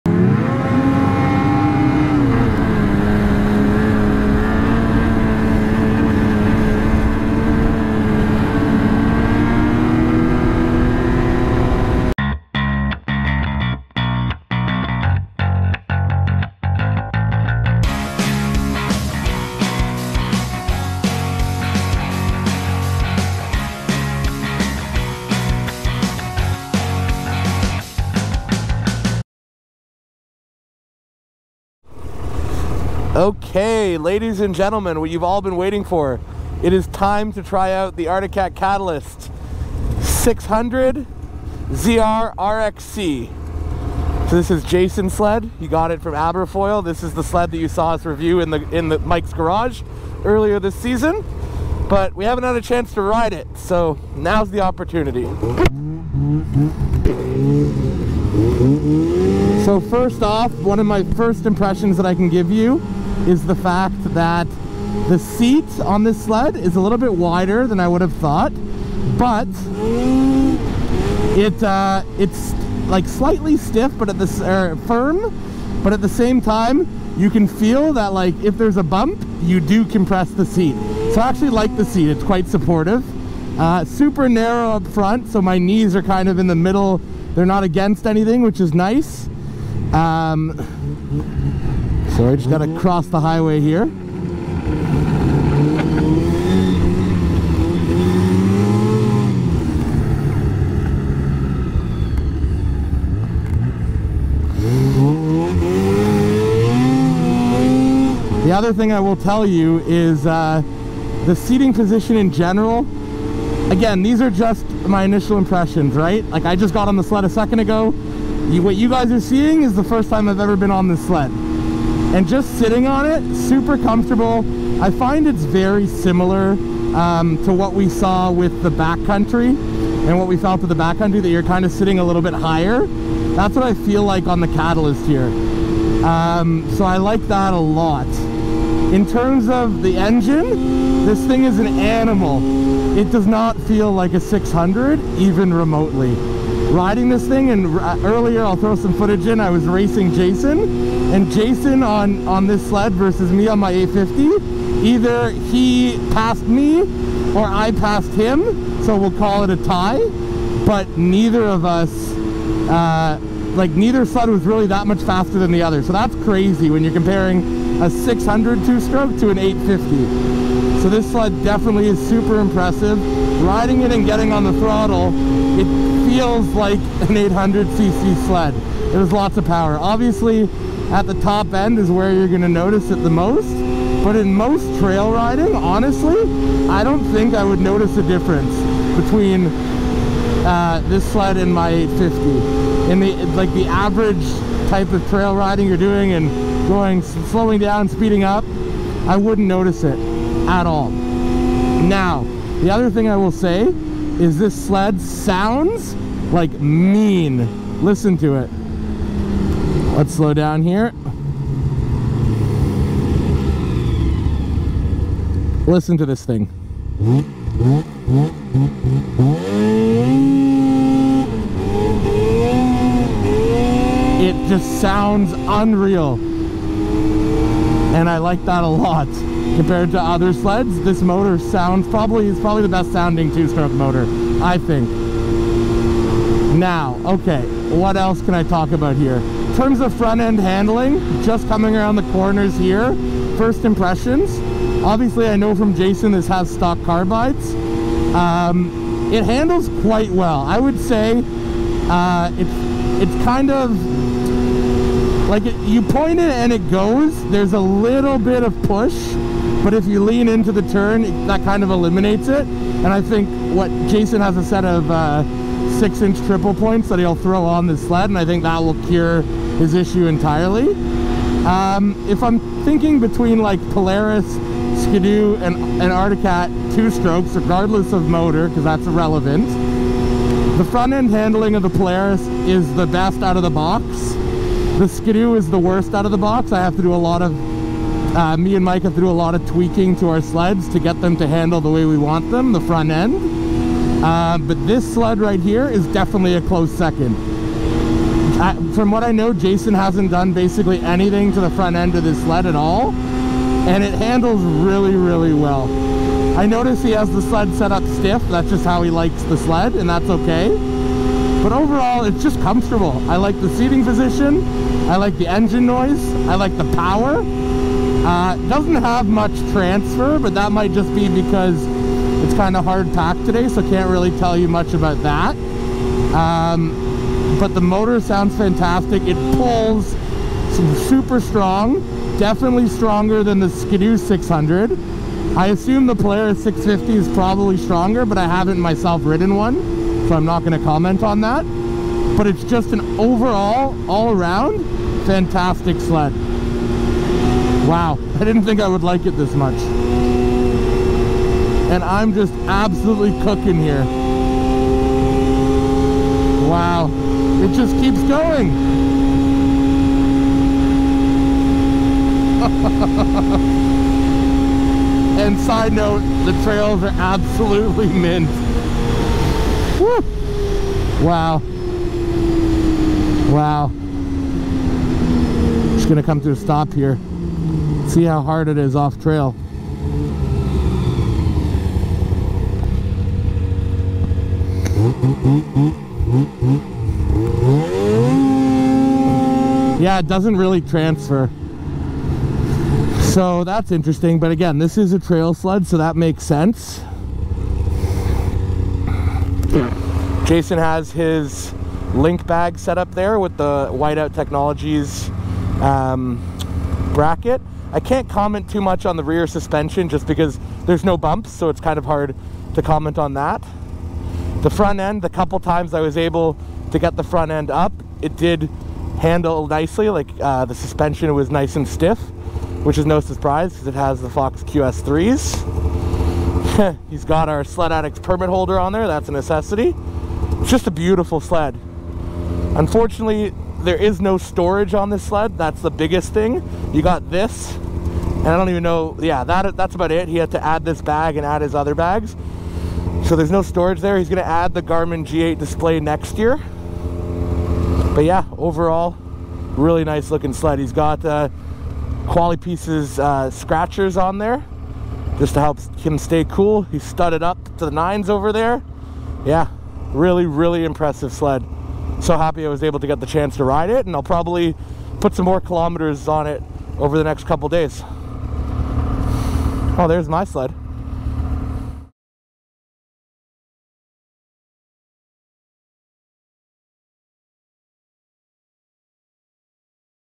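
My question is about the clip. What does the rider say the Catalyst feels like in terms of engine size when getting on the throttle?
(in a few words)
800cc.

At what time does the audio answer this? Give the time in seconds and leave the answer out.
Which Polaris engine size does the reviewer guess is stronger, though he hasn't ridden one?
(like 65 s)
336 s.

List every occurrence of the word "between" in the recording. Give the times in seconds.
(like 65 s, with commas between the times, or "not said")
189 s, 272 s.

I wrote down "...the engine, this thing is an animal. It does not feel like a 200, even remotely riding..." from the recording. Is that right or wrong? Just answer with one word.
wrong.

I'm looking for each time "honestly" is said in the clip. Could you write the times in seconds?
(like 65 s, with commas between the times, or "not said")
185 s.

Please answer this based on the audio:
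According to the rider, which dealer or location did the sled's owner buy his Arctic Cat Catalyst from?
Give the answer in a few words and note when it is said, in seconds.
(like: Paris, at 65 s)
Aberfoyle, at 46 s.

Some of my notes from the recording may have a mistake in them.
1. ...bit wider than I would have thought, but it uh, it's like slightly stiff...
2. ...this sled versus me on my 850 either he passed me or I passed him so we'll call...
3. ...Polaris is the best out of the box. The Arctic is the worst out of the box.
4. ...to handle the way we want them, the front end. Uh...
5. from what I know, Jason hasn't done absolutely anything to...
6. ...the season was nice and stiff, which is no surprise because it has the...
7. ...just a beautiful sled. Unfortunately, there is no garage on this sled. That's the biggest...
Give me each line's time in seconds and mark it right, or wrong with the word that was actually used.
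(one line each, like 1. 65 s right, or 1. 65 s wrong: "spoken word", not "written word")
1. 66 s right
2. 152 s right
3. 281 s wrong: "Skidoo", not "Arctic"
4. 291 s right
5. 298 s wrong: "basically", not "absolutely"
6. 420 s wrong: "suspension", not "season"
7. 430 s wrong: "storage", not "garage".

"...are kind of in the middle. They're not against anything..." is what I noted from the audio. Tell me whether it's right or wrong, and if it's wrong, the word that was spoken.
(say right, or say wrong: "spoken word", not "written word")
right.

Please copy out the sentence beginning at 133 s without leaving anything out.
That's what I feel like on the Catalyst here.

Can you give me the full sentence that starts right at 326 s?
Um, but the motor sounds fantastic.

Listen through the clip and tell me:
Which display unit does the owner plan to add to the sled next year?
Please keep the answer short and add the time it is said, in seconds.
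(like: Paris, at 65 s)
Garmin G8, at 444 s.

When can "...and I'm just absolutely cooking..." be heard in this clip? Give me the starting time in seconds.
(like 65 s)
351 s.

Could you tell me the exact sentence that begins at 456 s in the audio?
He's studded up to the nines over there.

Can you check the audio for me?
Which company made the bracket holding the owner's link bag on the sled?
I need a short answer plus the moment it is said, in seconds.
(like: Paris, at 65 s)
Whiteout Technologies, at 403 s.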